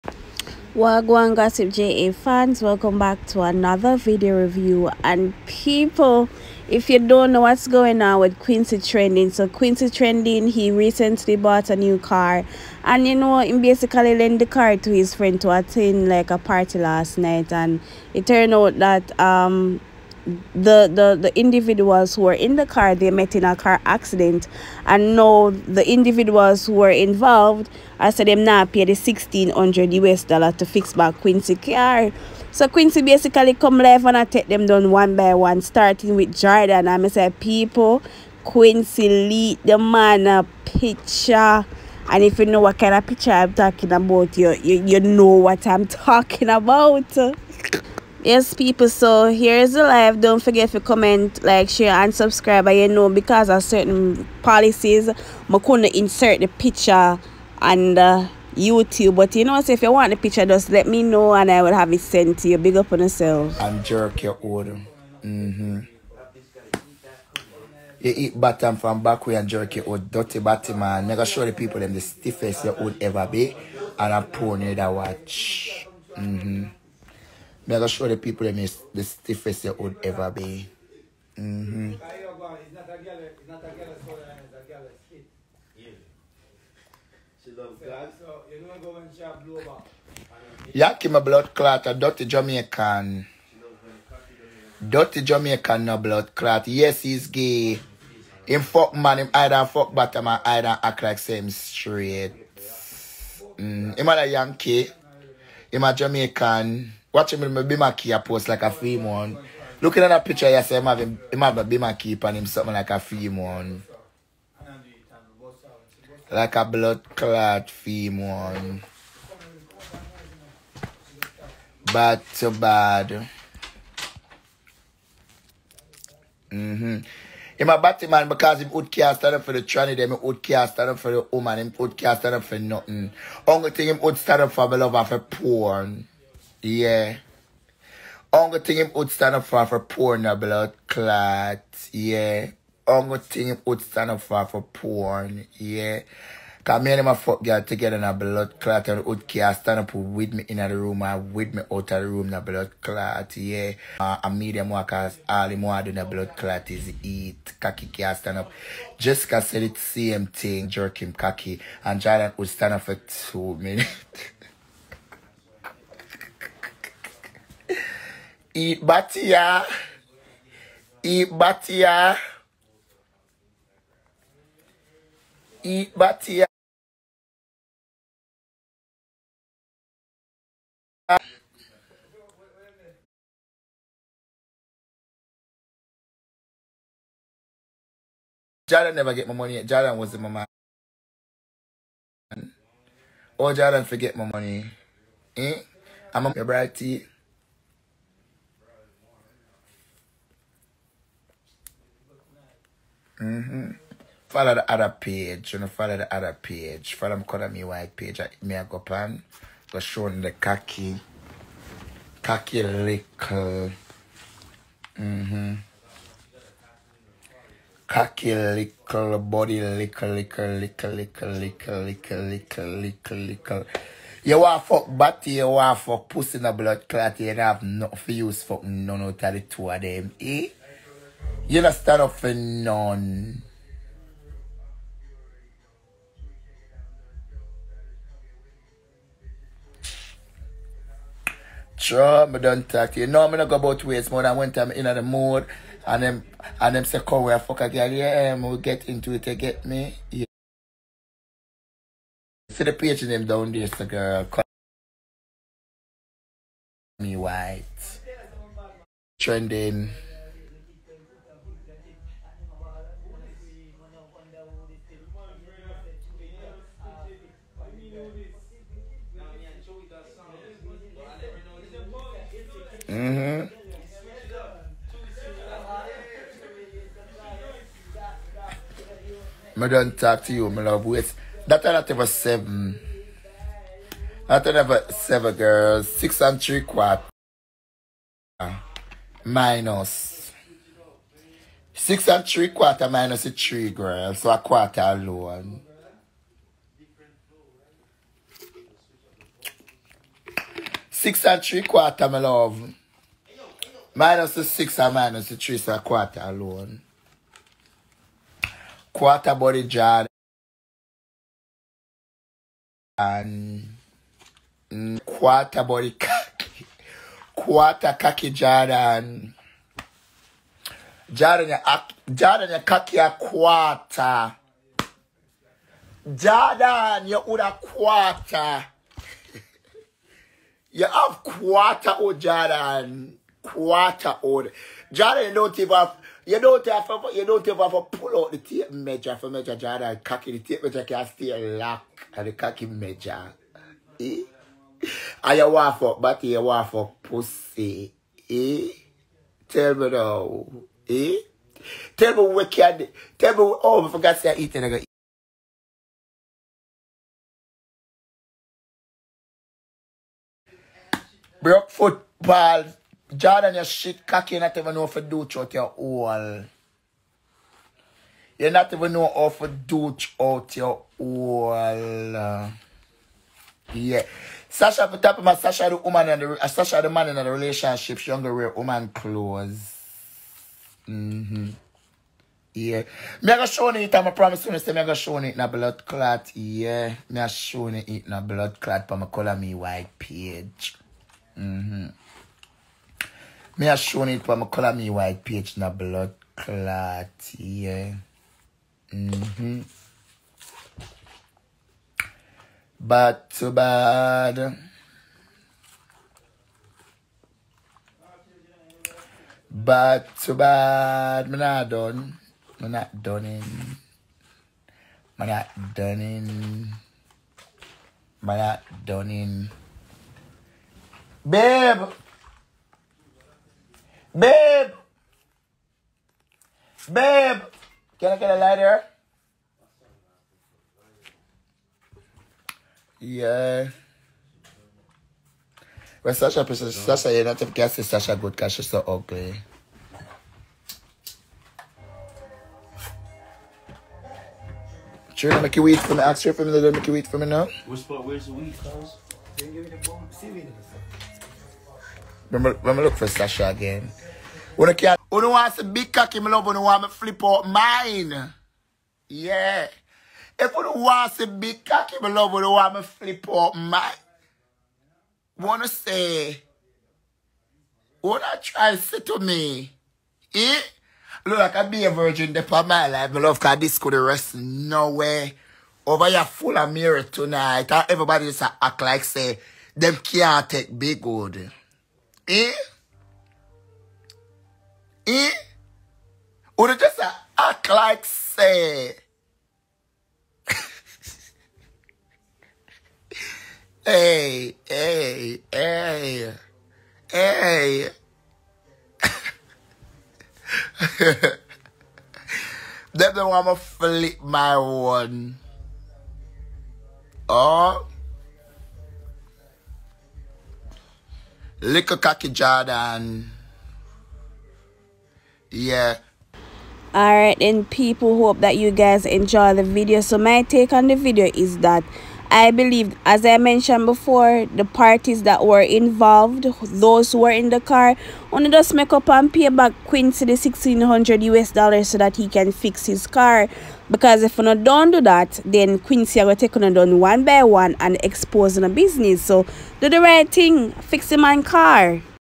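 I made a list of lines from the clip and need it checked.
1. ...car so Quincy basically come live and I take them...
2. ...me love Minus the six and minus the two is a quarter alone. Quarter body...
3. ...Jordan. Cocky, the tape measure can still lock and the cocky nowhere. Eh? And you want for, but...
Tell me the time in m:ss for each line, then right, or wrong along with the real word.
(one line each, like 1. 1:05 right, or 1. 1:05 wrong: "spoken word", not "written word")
1. 0:31 right
2. 5:02 wrong: "three", not "two"
3. 5:39 wrong: "measure", not "nowhere".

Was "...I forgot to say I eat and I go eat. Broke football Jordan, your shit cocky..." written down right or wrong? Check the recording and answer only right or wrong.
right.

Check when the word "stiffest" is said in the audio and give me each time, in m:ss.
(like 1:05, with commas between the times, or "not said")
1:12, 1:19.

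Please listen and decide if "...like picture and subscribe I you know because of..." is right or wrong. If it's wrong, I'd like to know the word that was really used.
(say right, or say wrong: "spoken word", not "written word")
wrong: "share", not "picture".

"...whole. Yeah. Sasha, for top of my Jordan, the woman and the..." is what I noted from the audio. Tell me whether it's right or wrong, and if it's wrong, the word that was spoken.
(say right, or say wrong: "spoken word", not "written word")
wrong: "Sasha", not "Jordan".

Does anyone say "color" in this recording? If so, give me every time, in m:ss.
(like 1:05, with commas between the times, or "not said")
3:27, 6:29, 6:34.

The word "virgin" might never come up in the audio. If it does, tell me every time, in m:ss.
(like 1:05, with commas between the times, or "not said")
7:51.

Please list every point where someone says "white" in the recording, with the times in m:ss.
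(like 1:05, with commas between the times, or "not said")
3:27, 4:17, 6:29, 6:34.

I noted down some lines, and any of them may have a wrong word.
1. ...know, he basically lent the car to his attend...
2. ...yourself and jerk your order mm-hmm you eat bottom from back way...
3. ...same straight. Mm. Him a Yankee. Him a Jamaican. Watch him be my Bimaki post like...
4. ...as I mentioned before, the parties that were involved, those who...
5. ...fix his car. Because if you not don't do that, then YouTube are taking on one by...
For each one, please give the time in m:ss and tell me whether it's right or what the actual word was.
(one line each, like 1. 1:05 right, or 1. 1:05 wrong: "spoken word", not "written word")
1. 0:13 wrong: "friend", not "attend"
2. 1:02 right
3. 1:41 right
4. 8:43 right
5. 8:52 wrong: "Quincy", not "YouTube".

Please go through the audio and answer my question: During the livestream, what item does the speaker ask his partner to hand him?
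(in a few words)
A lighter.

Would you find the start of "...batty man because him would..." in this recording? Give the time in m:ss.
2:07.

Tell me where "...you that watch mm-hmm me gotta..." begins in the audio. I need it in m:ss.
1:14.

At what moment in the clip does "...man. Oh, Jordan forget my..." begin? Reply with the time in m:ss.
3:10.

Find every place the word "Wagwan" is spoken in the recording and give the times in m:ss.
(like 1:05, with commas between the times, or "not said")
0:00.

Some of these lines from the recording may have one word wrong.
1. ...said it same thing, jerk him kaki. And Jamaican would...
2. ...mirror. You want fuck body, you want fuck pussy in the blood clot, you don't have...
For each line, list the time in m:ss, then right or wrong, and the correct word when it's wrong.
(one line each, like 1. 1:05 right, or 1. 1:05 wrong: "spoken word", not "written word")
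1. 2:39 wrong: "Jordan", not "Jamaican"
2. 3:43 wrong: "liquor", not "mirror".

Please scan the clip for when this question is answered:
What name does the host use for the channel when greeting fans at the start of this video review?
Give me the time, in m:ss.
0:01.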